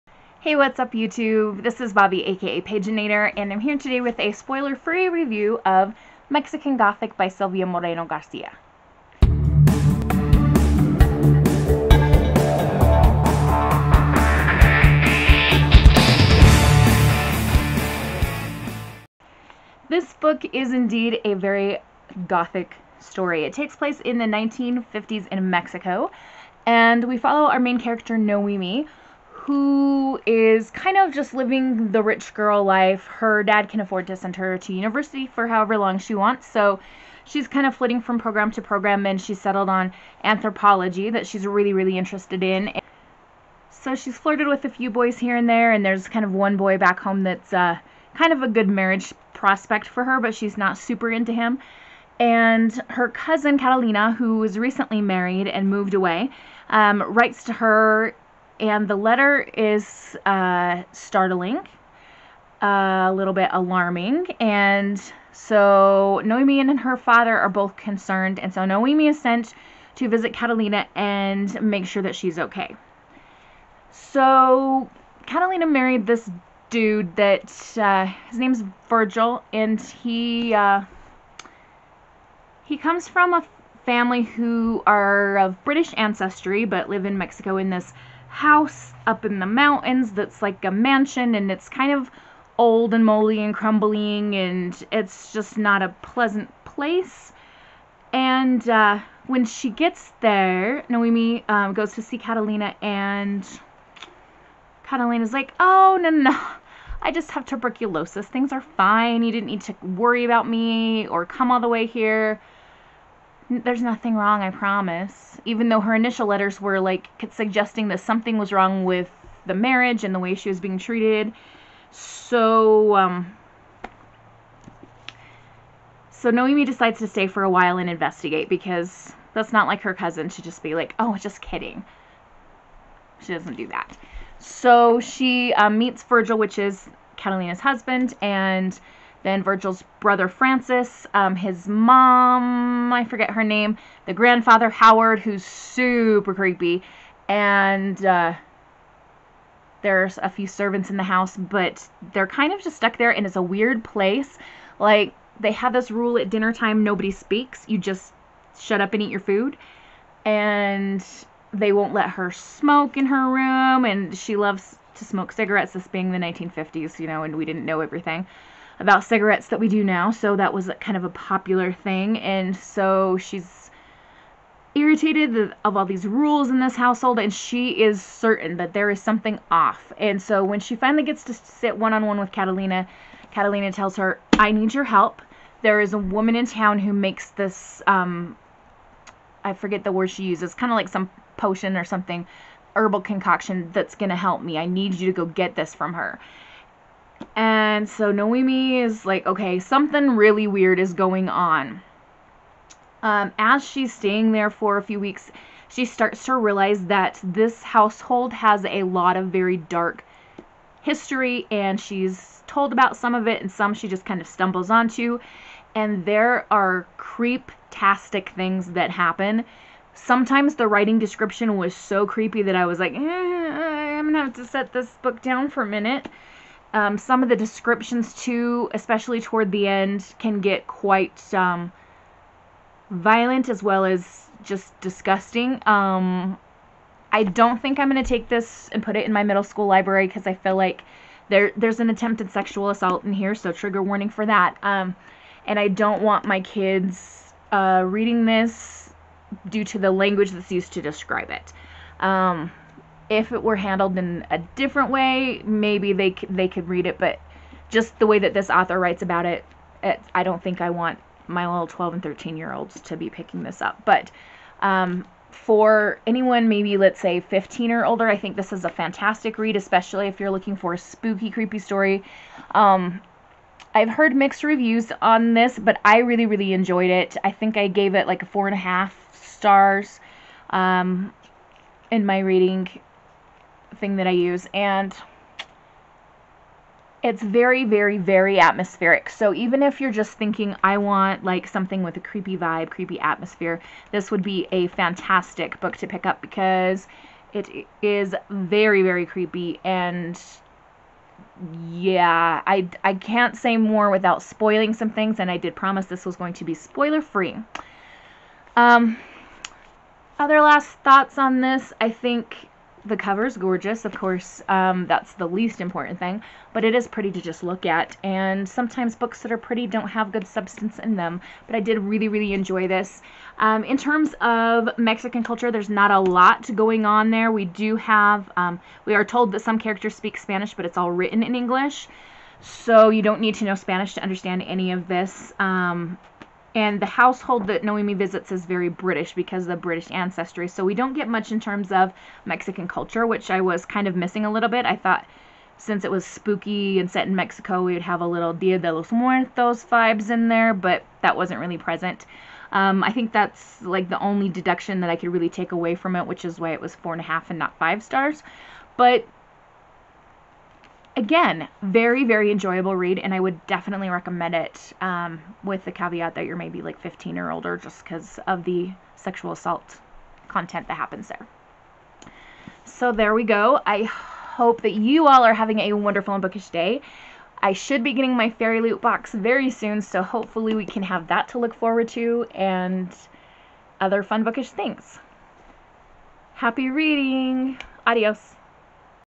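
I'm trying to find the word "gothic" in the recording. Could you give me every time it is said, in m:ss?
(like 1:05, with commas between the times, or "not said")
0:06, 0:22.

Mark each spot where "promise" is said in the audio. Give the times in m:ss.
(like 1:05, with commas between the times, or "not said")
1:54, 5:05.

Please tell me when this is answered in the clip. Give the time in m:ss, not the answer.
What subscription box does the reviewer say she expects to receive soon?
6:18.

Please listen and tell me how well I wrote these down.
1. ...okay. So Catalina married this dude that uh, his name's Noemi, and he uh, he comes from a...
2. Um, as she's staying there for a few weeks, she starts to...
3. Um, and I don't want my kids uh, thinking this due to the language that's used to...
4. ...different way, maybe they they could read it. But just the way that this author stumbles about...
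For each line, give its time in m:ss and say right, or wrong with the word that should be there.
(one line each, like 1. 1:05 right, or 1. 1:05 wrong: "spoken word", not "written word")
1. 1:12 wrong: "Virgil", not "Noemi"
2. 3:23 right
3. 4:04 wrong: "reading", not "thinking"
4. 4:14 wrong: "writes", not "stumbles".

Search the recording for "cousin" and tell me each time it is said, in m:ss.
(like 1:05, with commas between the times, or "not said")
0:53, 2:09.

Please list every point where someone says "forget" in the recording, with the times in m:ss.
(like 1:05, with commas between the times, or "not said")
2:23, 3:09.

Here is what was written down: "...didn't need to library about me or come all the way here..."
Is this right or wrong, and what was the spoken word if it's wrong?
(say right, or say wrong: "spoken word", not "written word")
wrong: "worry", not "library".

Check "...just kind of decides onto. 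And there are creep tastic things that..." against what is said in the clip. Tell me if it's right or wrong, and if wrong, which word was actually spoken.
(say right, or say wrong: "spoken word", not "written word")
wrong: "stumbles", not "decides".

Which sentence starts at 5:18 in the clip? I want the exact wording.
And sometimes books that are pretty don't have good substance in them, but I did really, really enjoy this.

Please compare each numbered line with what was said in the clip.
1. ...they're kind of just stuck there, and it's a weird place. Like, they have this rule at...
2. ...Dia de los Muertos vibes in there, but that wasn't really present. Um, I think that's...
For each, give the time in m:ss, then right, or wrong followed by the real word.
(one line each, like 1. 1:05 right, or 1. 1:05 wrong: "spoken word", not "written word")
1. 2:32 right
2. 5:48 right.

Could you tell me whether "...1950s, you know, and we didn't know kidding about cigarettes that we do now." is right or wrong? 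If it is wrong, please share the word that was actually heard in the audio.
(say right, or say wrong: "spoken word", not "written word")
wrong: "everything", not "kidding".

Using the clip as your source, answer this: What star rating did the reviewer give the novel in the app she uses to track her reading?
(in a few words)
4.5 stars.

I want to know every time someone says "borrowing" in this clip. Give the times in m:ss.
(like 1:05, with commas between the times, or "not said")
not said.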